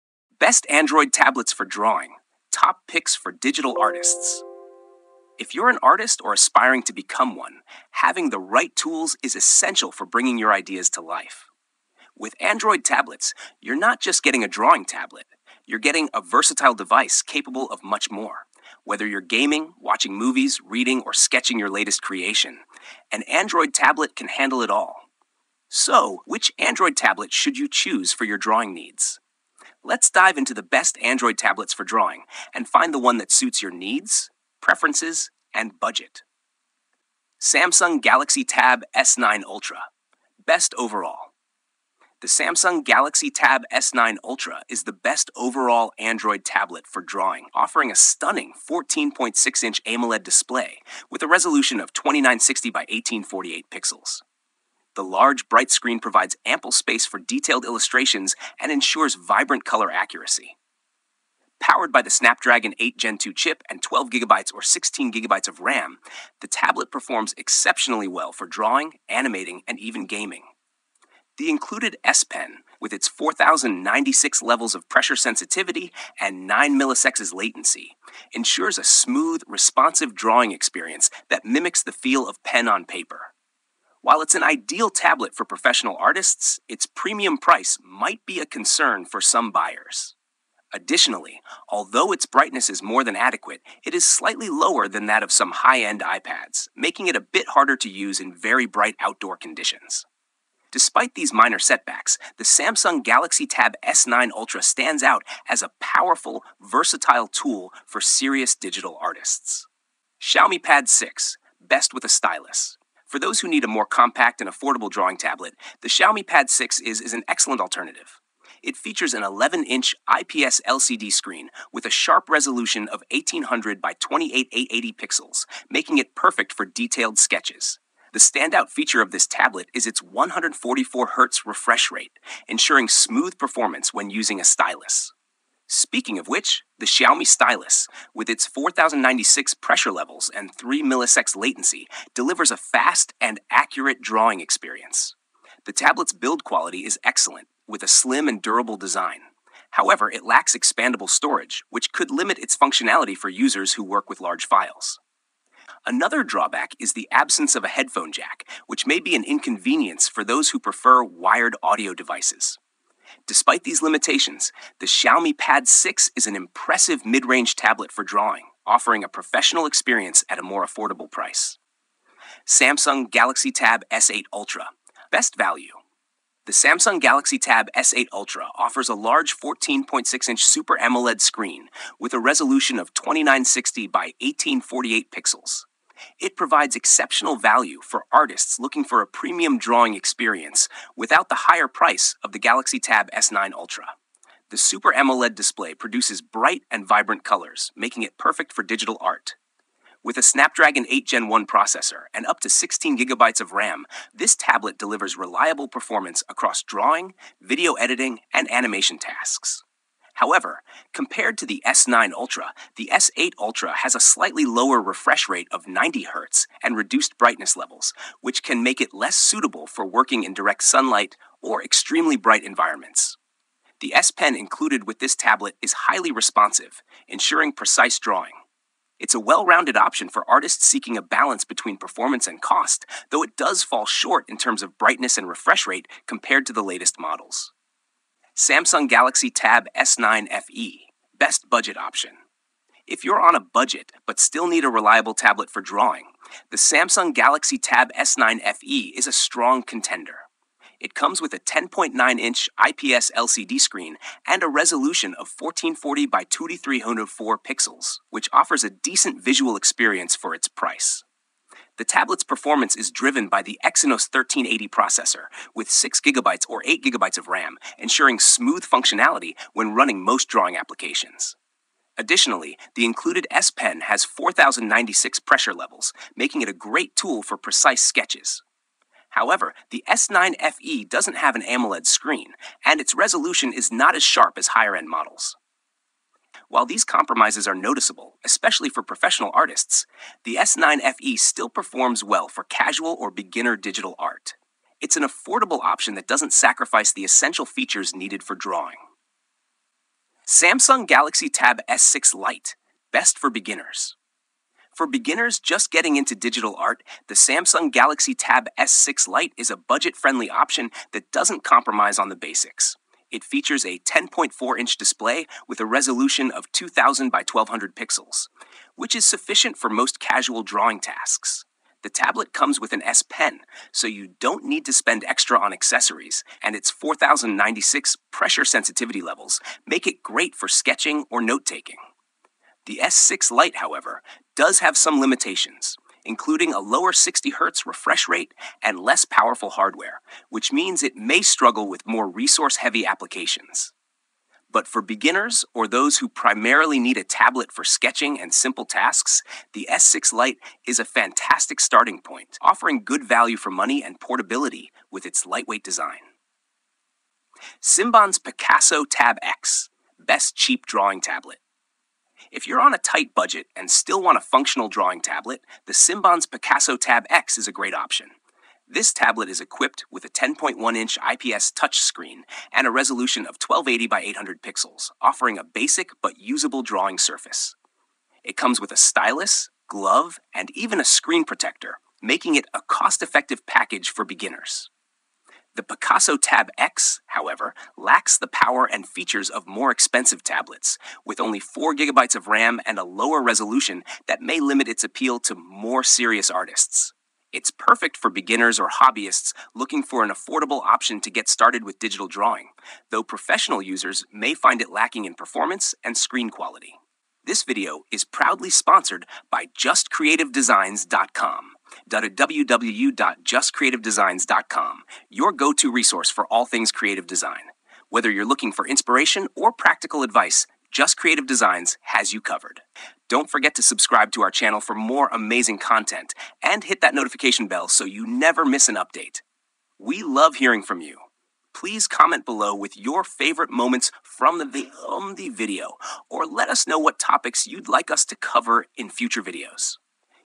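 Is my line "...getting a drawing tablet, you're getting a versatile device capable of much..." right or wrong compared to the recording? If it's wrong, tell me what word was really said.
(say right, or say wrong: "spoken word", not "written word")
right.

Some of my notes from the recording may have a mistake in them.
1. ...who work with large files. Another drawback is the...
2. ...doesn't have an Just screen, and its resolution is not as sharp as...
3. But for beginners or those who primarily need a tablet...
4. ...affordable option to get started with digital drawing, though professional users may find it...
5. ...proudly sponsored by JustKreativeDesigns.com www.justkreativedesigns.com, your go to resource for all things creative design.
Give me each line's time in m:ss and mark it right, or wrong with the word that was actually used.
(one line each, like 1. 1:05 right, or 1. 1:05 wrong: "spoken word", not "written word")
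1. 2:33 right
2. 4:40 wrong: "AMOLED", not "Just"
3. 5:44 right
4. 6:40 right
5. 6:48 right.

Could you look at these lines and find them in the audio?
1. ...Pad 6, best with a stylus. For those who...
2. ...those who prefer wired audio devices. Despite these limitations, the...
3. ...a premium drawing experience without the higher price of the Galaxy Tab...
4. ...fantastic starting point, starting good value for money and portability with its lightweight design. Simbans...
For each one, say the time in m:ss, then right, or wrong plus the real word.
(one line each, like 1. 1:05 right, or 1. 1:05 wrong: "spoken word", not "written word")
1. 1:50 right
2. 2:40 right
3. 3:09 right
4. 5:50 wrong: "offering", not "starting".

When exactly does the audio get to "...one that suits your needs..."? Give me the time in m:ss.
0:32.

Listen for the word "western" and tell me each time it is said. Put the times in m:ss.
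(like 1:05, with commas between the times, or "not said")
not said.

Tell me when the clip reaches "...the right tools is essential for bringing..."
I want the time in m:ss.
0:08.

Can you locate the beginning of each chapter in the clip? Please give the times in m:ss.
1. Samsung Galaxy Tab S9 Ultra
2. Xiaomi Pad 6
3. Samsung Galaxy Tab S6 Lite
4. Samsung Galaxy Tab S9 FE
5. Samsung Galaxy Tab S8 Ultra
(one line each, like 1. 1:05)
1. 0:39
2. 1:51
3. 5:00
4. 4:00
5. 2:54.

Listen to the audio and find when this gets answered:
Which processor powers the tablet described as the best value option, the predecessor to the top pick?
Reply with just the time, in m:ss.
3:20.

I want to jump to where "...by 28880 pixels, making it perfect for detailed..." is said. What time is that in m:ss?
2:03.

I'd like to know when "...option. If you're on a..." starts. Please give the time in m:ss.
4:01.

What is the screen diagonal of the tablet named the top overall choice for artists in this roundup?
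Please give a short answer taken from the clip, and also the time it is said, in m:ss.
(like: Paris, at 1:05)
14.6-inch, at 0:48.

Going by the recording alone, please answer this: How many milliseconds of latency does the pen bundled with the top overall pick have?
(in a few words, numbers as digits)
9 milliseconds.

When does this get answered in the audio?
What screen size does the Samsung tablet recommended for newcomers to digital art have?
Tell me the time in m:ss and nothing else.
5:13.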